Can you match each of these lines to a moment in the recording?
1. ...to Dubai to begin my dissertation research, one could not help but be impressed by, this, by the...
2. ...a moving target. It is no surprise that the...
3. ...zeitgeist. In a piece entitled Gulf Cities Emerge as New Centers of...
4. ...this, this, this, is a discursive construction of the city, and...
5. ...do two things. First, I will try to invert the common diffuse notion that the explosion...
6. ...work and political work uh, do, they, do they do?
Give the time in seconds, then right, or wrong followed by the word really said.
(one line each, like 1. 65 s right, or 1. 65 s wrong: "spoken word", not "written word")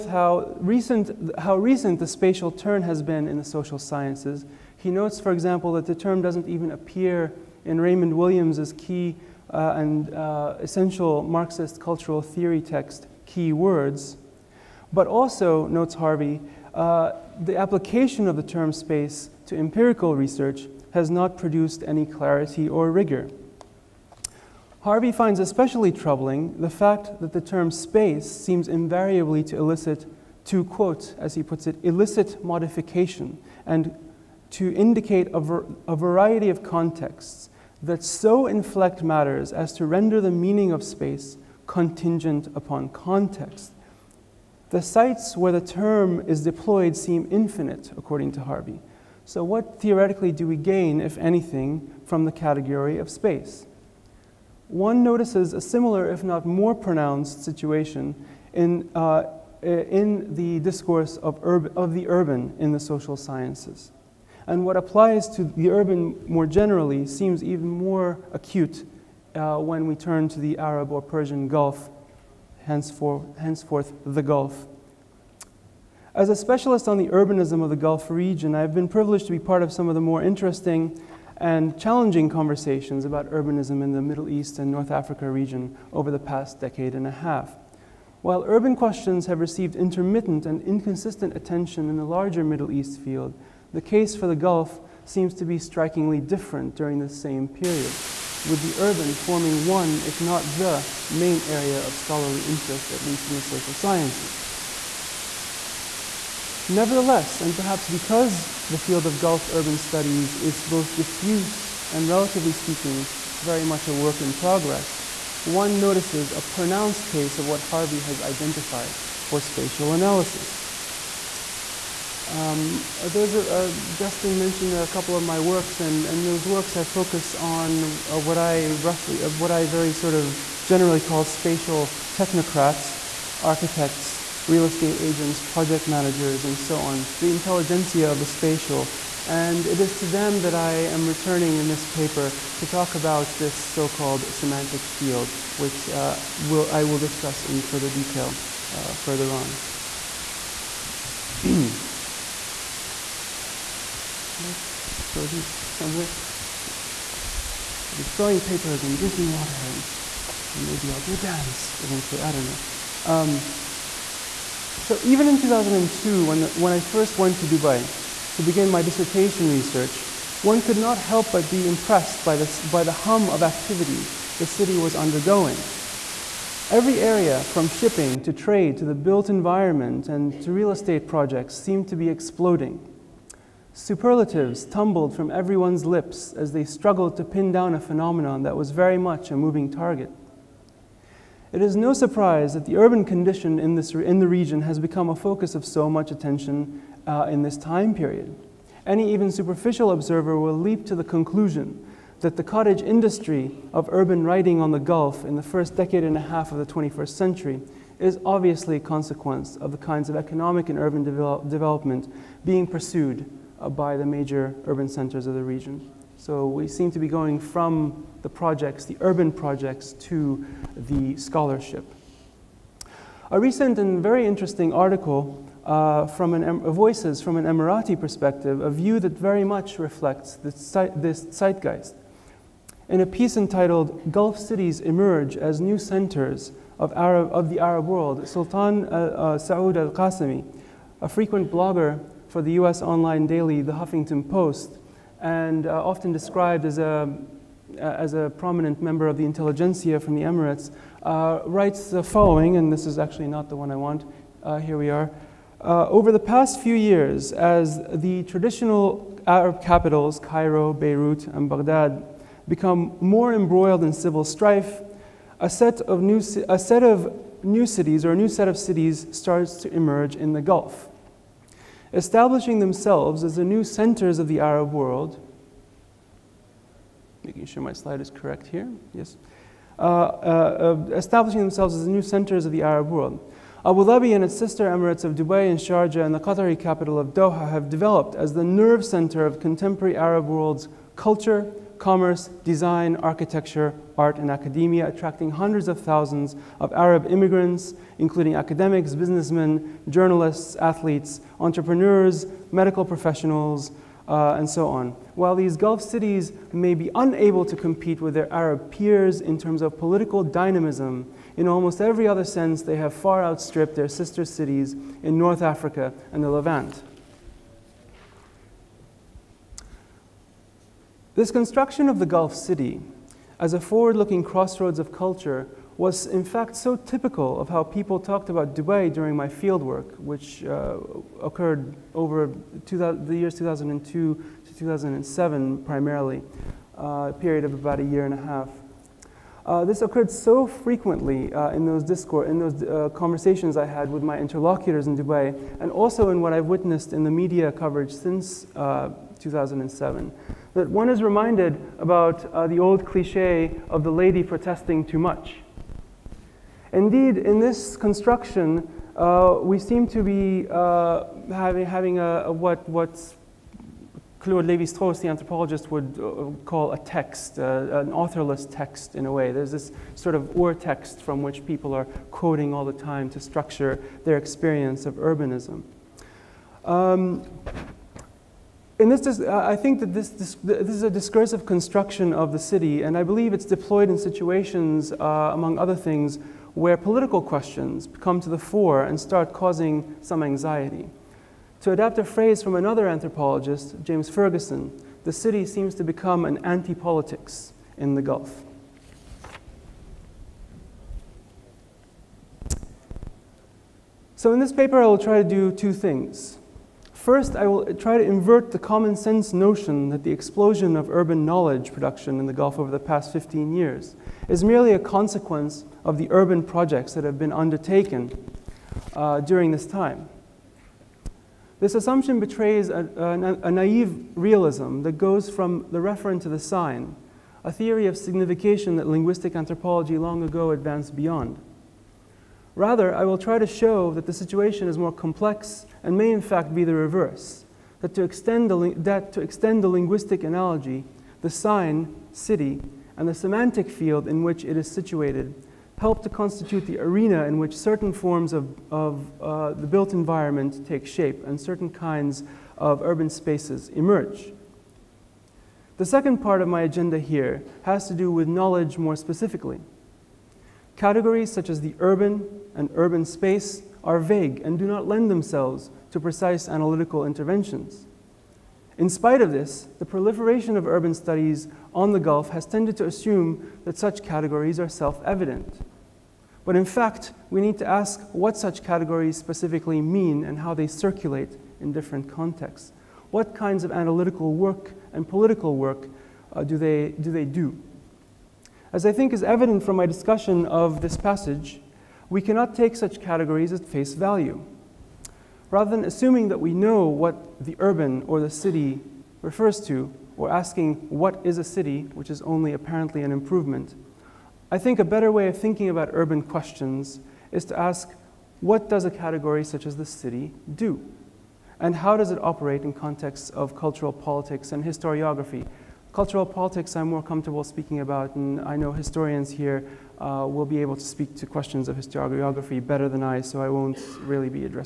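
1. 167 s right
2. 189 s right
3. 231 s right
4. 379 s right
5. 405 s wrong: "sense", not "diffuse"
6. 484 s right.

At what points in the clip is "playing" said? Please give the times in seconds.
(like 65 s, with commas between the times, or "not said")
not said.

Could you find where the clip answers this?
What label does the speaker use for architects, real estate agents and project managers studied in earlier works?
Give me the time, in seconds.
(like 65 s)
131 s.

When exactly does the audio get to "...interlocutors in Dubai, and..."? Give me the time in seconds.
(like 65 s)
344 s.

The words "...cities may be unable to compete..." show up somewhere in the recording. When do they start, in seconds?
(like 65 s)
305 s.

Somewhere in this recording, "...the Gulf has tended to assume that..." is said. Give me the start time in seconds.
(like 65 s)
471 s.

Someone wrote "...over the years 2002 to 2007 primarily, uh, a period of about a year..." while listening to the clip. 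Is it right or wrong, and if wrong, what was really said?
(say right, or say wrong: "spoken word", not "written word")
right.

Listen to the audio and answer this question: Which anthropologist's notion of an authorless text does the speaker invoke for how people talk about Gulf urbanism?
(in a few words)
Claude Lévi-Strauss.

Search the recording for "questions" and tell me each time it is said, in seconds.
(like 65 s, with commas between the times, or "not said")
88 s, 387 s, 506 s, 521 s.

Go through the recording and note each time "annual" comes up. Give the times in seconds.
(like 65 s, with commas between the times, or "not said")
not said.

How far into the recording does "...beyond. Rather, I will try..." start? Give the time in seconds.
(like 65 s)
430 s.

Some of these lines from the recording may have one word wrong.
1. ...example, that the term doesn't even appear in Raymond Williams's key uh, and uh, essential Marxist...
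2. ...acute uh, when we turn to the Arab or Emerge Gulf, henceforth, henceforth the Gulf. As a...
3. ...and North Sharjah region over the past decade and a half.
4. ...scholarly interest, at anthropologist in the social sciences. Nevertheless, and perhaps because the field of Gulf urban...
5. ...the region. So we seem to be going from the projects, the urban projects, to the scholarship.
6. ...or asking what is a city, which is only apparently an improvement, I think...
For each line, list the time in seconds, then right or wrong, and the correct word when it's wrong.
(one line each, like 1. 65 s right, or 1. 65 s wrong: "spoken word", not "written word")
1. 5 s right
2. 68 s wrong: "Persian", not "Emerge"
3. 84 s wrong: "Africa", not "Sharjah"
4. 101 s wrong: "least", not "anthropologist"
5. 215 s right
6. 500 s right.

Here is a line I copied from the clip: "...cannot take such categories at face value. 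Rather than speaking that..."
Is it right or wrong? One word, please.
wrong.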